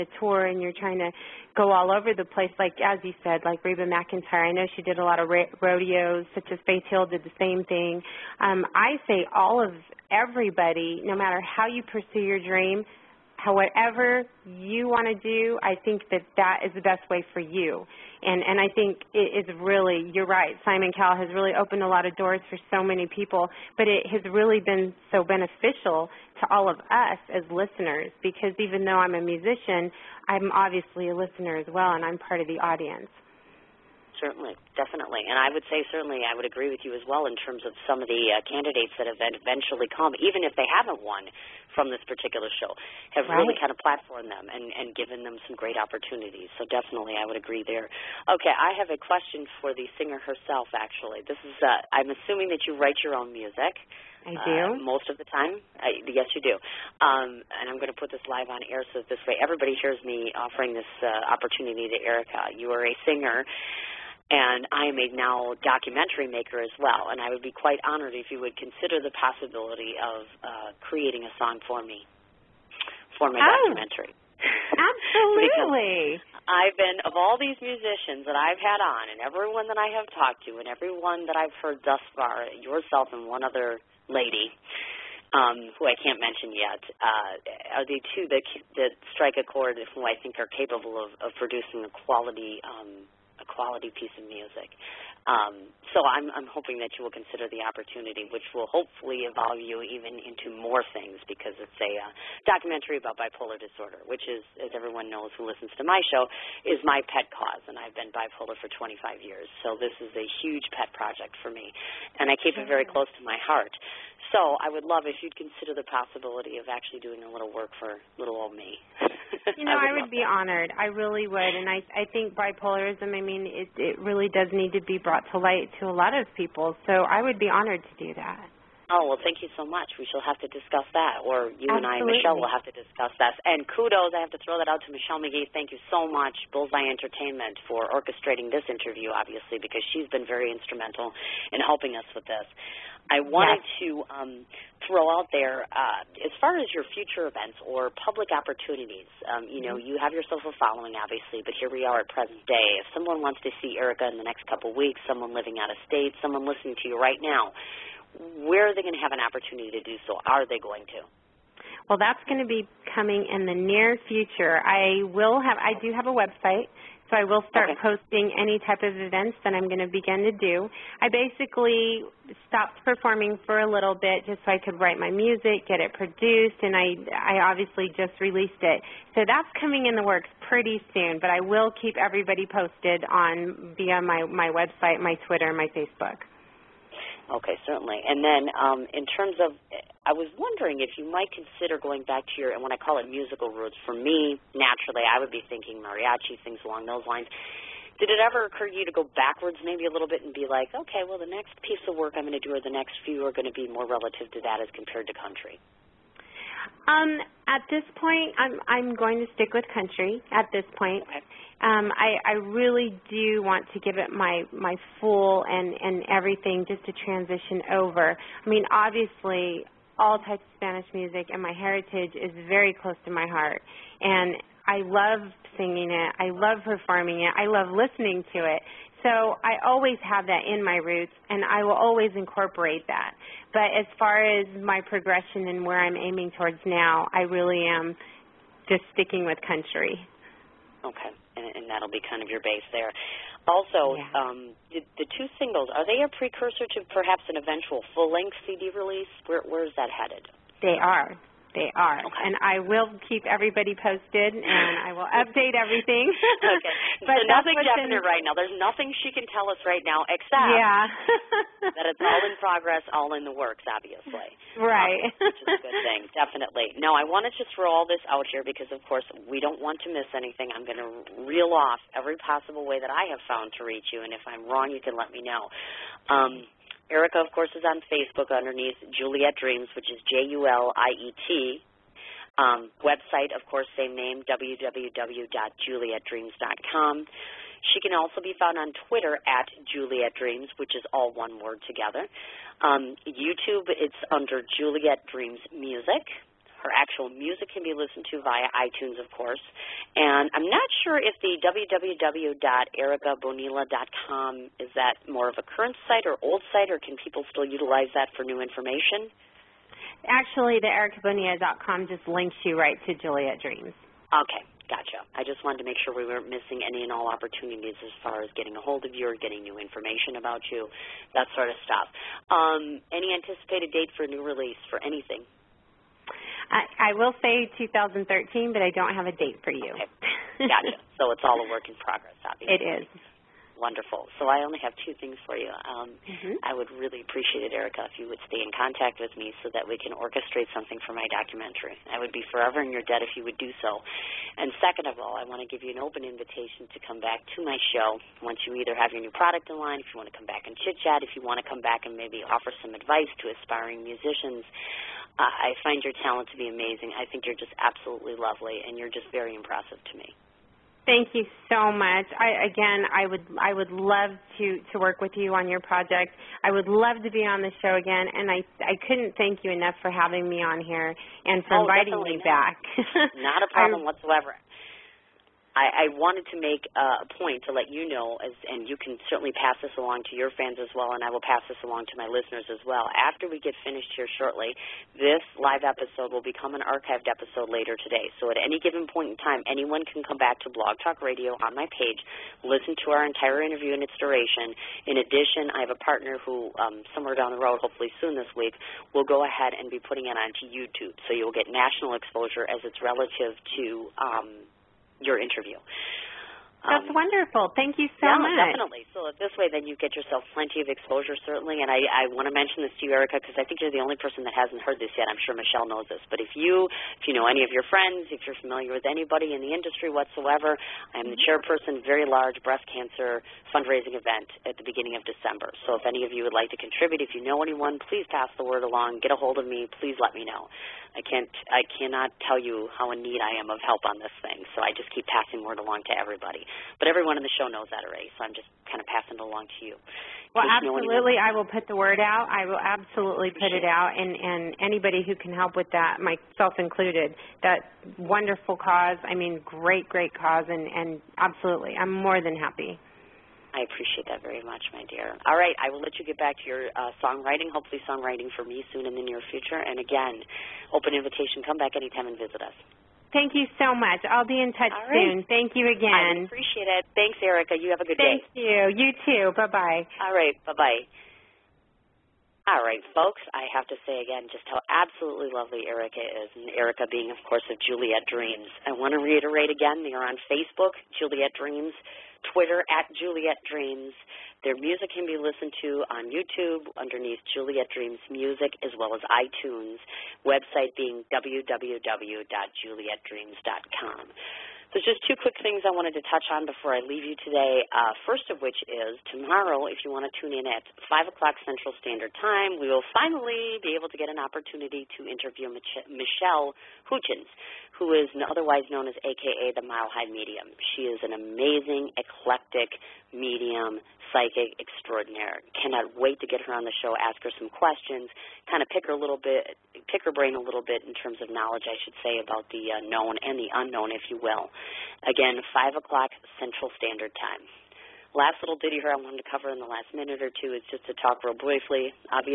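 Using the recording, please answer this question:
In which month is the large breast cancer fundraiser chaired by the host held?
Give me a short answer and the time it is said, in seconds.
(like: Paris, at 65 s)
December, at 425 s.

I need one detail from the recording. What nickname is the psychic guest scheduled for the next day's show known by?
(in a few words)
the Mile High Medium.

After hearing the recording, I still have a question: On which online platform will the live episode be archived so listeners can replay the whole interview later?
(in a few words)
Blog Talk Radio.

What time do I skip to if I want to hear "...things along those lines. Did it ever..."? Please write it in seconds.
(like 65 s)
196 s.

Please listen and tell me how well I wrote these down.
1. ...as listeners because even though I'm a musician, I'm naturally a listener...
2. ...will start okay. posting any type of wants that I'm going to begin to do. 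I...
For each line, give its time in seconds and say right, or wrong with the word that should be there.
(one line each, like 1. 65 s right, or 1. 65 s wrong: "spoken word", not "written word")
1. 27 s wrong: "obviously", not "naturally"
2. 167 s wrong: "events", not "wants".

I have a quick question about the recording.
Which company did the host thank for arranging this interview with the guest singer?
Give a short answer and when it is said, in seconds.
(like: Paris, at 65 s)
Bullseye Entertainment, at 136 s.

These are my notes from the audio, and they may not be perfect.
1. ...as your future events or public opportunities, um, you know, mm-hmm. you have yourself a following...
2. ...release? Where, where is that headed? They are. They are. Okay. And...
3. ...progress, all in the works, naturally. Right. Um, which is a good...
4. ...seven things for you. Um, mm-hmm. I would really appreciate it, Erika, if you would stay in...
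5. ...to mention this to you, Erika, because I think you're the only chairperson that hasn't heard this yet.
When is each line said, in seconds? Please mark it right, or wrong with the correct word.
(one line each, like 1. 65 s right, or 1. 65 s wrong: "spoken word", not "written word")
1. 146 s right
2. 248 s right
3. 262 s wrong: "obviously", not "naturally"
4. 334 s wrong: "two", not "seven"
5. 412 s wrong: "person", not "chairperson".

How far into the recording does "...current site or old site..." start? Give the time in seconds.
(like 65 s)
305 s.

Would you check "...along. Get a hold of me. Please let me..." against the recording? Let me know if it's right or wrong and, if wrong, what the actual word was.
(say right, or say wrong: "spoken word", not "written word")
right.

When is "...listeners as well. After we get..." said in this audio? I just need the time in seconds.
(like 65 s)
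382 s.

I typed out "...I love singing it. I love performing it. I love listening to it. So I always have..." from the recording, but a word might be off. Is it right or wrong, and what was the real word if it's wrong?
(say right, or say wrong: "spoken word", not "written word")
right.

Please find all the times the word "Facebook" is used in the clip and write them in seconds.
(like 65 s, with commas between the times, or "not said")
185 s, 277 s, 480 s.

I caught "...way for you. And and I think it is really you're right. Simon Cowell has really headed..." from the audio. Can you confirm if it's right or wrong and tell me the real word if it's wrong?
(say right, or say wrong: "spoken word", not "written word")
wrong: "opened", not "headed".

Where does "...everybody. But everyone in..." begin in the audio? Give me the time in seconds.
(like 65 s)
435 s.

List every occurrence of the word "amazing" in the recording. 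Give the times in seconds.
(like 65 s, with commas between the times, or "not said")
356 s, 511 s.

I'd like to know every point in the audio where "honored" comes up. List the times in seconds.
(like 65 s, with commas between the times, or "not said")
67 s, 120 s, 127 s.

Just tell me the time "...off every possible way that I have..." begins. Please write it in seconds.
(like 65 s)
271 s.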